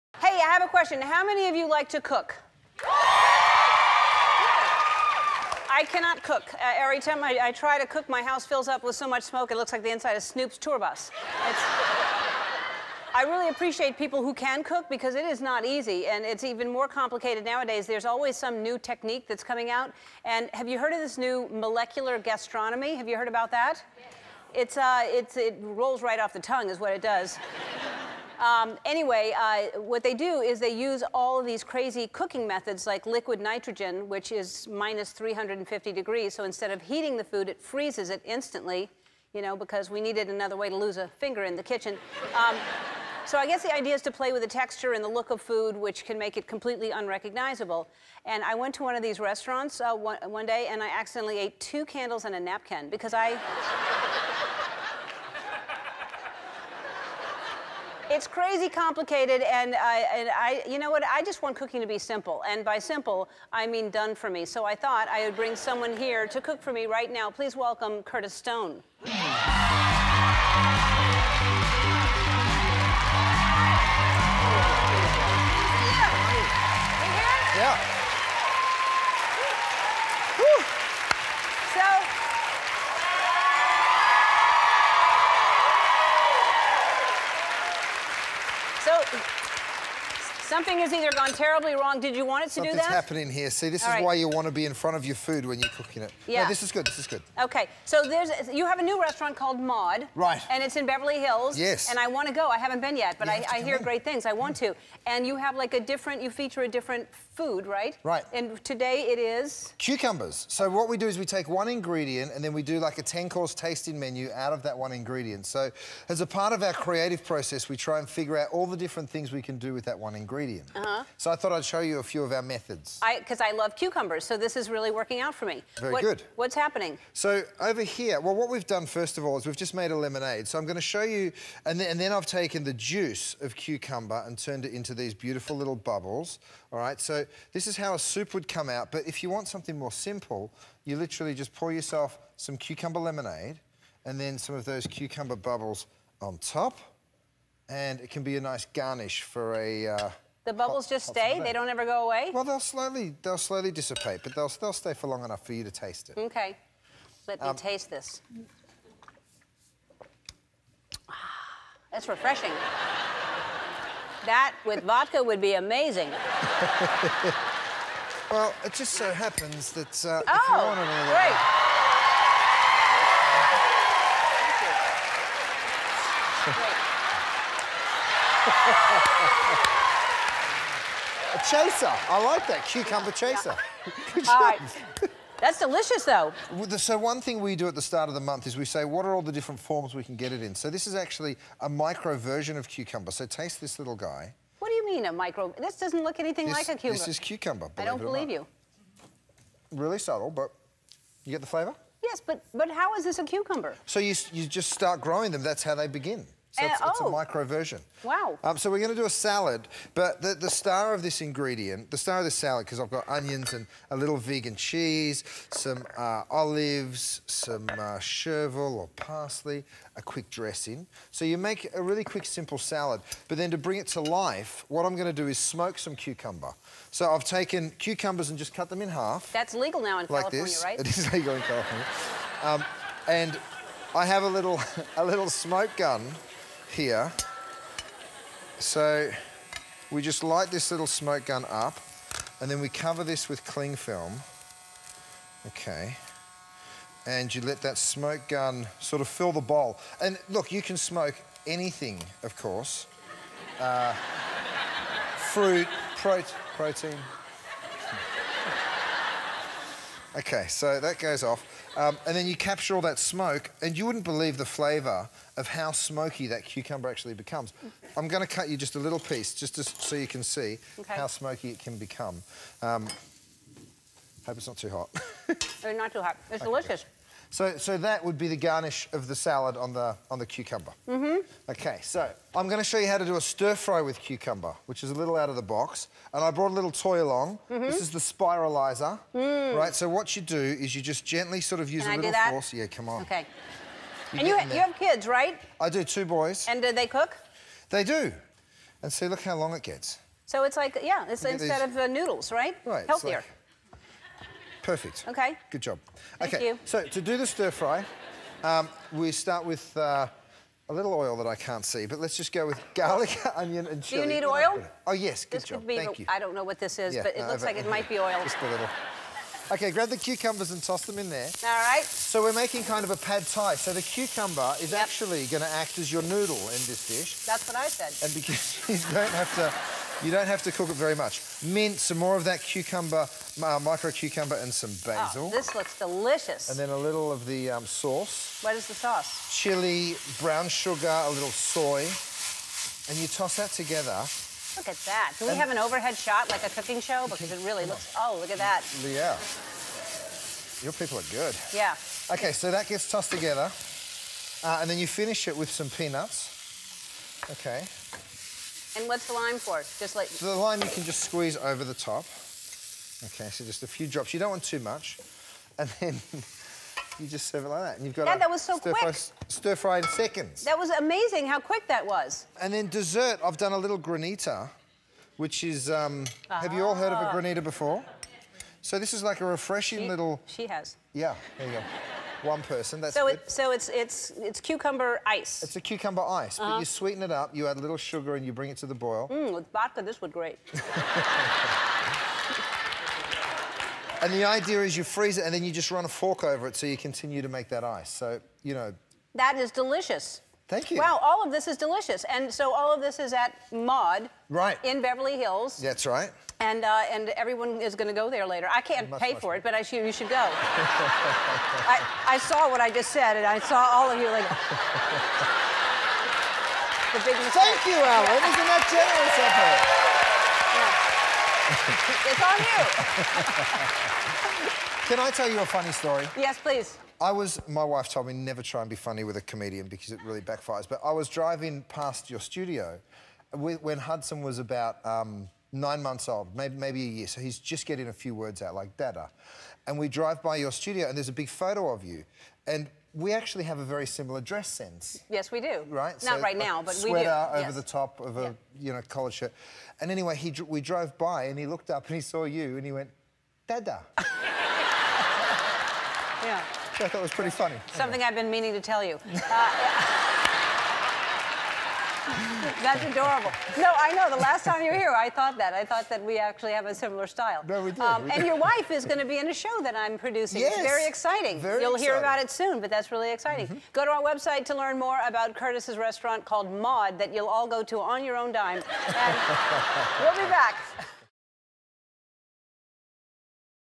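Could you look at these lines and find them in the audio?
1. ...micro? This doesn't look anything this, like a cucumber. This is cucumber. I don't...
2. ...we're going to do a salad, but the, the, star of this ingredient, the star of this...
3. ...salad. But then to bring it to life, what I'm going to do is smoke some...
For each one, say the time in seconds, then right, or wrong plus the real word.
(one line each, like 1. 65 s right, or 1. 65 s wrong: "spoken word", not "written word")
1. 195 s right
2. 208 s right
3. 222 s right.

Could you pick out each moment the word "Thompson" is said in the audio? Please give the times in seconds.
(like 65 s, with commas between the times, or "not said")
not said.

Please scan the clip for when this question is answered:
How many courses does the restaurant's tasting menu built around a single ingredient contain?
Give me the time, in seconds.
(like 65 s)
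113 s.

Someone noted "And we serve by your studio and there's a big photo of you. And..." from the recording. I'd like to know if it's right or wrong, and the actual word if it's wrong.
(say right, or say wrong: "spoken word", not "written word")
wrong: "drive", not "serve".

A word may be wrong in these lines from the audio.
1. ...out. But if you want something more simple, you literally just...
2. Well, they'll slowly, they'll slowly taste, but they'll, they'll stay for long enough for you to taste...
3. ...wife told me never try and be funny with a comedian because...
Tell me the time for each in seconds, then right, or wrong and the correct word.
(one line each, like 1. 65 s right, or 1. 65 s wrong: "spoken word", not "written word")
1. 138 s right
2. 152 s wrong: "dissipate", not "taste"
3. 427 s right.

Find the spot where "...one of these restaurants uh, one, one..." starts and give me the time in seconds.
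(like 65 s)
48 s.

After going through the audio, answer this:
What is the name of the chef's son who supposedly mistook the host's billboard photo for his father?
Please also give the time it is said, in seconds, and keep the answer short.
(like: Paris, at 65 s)
Hudson, at 433 s.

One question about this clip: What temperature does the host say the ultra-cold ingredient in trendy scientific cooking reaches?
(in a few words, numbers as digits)
-350 degrees.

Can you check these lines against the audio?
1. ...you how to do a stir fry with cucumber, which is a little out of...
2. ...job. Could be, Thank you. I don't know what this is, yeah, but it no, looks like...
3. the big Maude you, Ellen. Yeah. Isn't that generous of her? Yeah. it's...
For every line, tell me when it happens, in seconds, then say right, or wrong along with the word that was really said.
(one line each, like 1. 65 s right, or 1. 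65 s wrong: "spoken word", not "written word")
1. 282 s right
2. 315 s right
3. 416 s wrong: "Thank", not "Maude".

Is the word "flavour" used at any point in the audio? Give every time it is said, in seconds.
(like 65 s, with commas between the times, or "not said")
201 s, 264 s.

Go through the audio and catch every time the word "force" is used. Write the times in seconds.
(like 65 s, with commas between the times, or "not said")
292 s.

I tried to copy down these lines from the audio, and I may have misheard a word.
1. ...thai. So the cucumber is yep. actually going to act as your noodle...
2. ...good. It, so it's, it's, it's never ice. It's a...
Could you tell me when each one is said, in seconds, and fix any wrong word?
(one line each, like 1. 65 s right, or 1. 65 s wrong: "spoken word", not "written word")
1. 323 s right
2. 383 s wrong: "cucumber", not "never".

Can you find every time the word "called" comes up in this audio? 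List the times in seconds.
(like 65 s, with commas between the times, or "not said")
99 s, 476 s.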